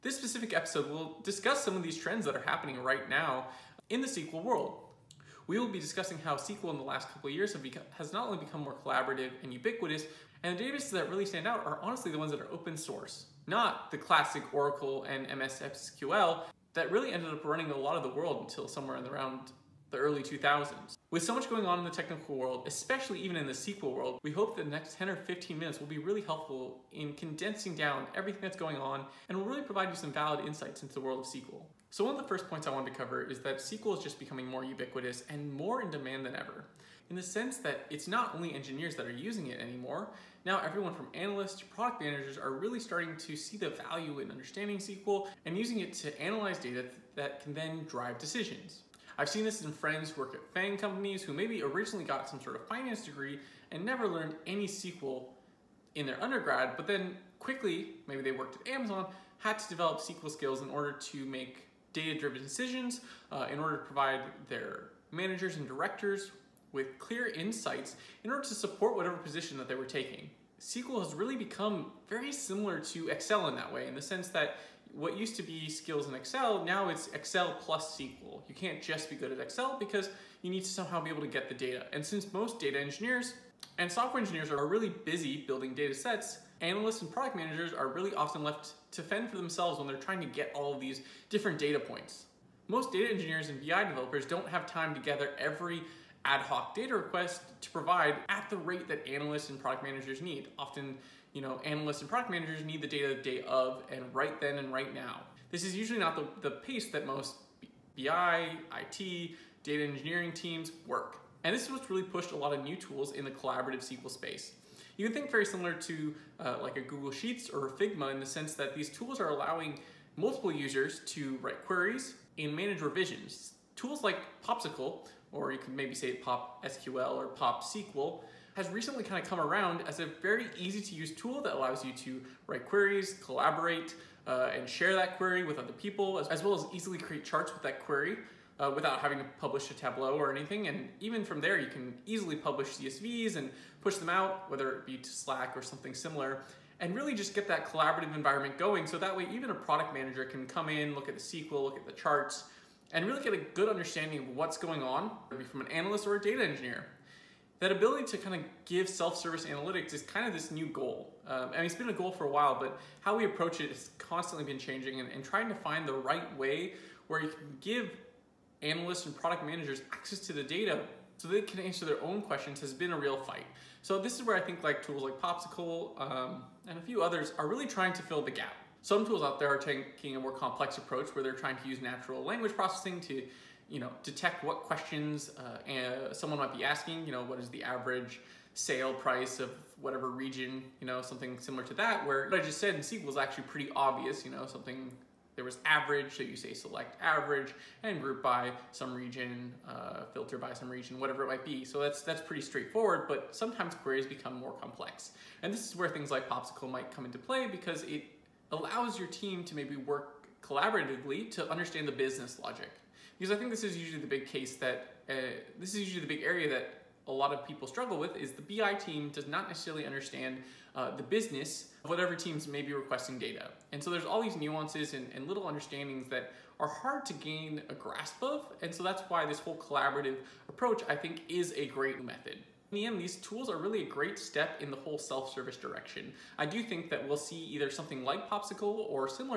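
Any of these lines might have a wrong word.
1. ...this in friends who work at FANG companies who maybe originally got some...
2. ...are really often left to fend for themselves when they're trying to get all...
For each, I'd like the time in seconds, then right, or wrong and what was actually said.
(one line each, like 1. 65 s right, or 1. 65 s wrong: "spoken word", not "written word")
1. 49 s right
2. 87 s right.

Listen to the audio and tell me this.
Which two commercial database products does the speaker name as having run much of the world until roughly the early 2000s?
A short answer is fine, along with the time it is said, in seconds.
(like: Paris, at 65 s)
Oracle and MS SQL, at 14 s.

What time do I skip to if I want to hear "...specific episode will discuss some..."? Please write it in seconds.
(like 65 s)
0 s.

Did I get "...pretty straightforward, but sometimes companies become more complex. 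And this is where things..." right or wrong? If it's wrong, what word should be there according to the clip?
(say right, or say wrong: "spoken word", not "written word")
wrong: "queries", not "companies".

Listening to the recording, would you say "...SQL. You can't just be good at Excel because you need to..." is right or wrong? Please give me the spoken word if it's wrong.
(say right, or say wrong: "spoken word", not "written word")
right.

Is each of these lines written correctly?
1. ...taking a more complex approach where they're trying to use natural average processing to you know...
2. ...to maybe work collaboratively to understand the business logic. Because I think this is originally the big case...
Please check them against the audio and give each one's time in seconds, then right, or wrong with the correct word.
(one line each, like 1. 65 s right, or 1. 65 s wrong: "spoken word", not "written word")
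1. 179 s wrong: "language", not "average"
2. 209 s wrong: "usually", not "originally".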